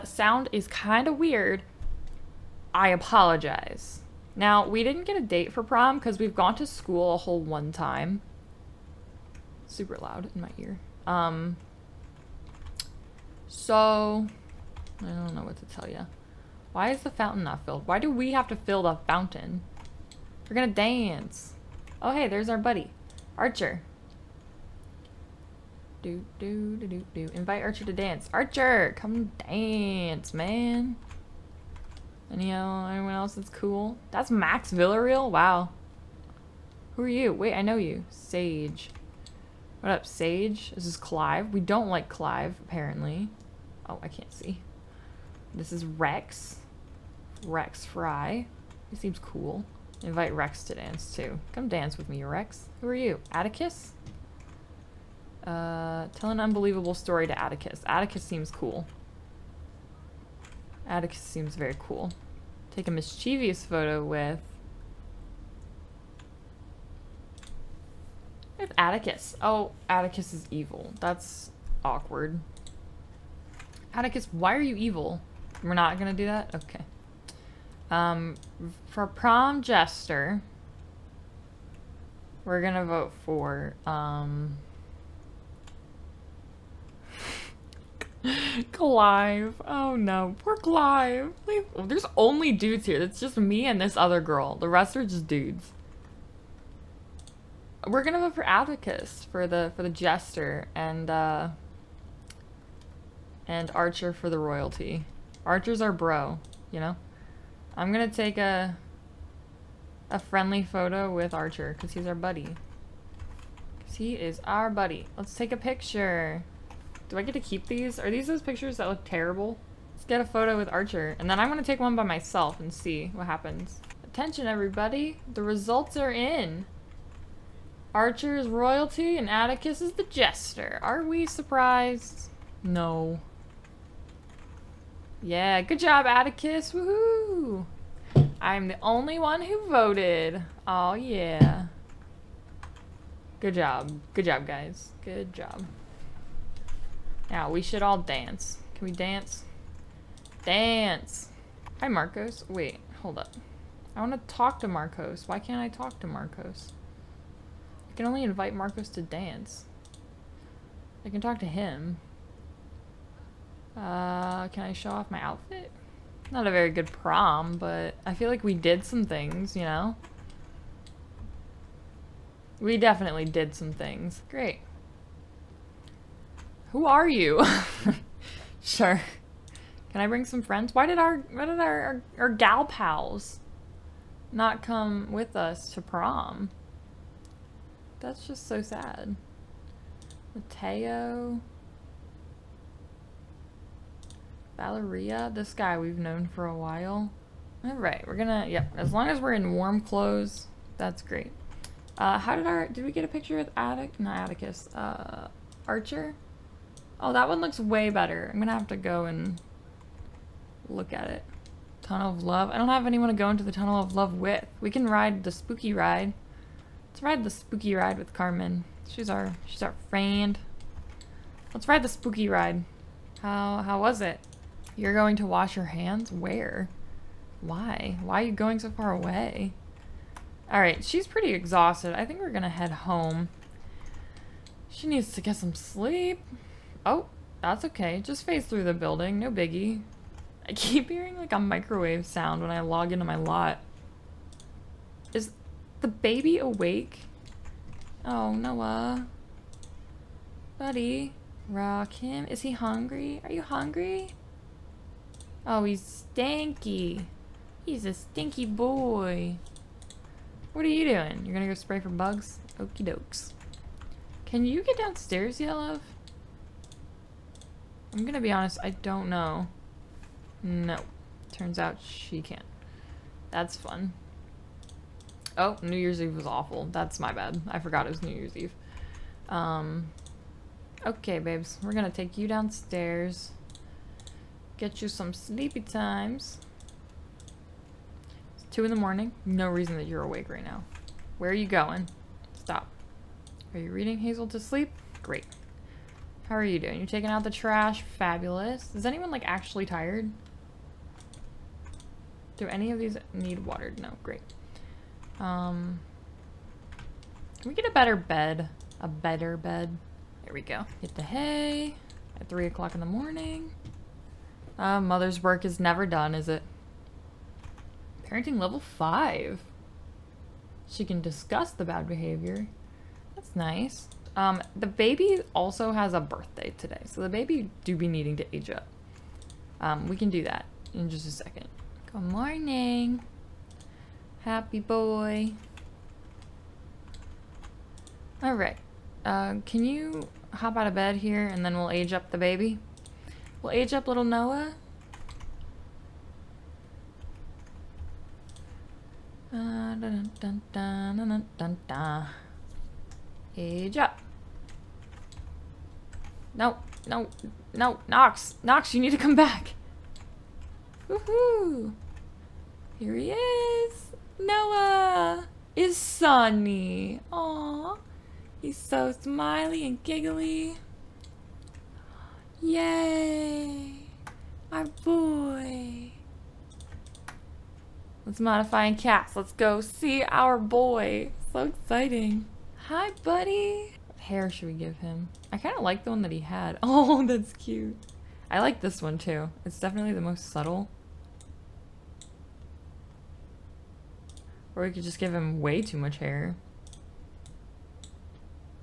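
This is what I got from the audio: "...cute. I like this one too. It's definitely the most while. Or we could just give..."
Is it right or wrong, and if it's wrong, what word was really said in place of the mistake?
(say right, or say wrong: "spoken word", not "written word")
wrong: "subtle", not "while".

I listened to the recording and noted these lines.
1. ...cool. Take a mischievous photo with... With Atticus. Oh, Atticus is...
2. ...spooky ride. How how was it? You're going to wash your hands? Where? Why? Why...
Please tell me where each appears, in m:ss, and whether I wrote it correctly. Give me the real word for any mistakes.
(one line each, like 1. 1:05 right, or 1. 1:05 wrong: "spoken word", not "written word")
1. 1:01 right
2. 3:41 right.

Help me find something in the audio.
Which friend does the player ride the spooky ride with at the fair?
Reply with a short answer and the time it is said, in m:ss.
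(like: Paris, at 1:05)
Carmen, at 3:38.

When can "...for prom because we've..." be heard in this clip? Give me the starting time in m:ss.
0:05.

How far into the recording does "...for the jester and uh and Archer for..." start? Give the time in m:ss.
1:39.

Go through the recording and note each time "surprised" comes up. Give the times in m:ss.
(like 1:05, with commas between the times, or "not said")
2:11.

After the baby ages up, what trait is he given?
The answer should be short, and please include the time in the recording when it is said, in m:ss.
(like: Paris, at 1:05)
Sunny, at 6:05.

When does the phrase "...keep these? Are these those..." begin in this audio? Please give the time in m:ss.
1:57.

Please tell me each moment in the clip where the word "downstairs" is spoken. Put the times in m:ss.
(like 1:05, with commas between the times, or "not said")
4:24, 4:42.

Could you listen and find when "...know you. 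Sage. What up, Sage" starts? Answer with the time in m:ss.
0:37.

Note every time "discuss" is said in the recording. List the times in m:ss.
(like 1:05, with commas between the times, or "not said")
5:21.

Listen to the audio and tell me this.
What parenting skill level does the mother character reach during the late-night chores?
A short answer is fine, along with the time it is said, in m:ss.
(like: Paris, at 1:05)
5, at 5:18.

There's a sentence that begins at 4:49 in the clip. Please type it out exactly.
No reason that you're awake right now.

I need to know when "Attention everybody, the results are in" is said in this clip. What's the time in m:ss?
2:04.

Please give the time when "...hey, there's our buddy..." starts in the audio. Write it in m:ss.
0:22.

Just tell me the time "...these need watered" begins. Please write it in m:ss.
5:02.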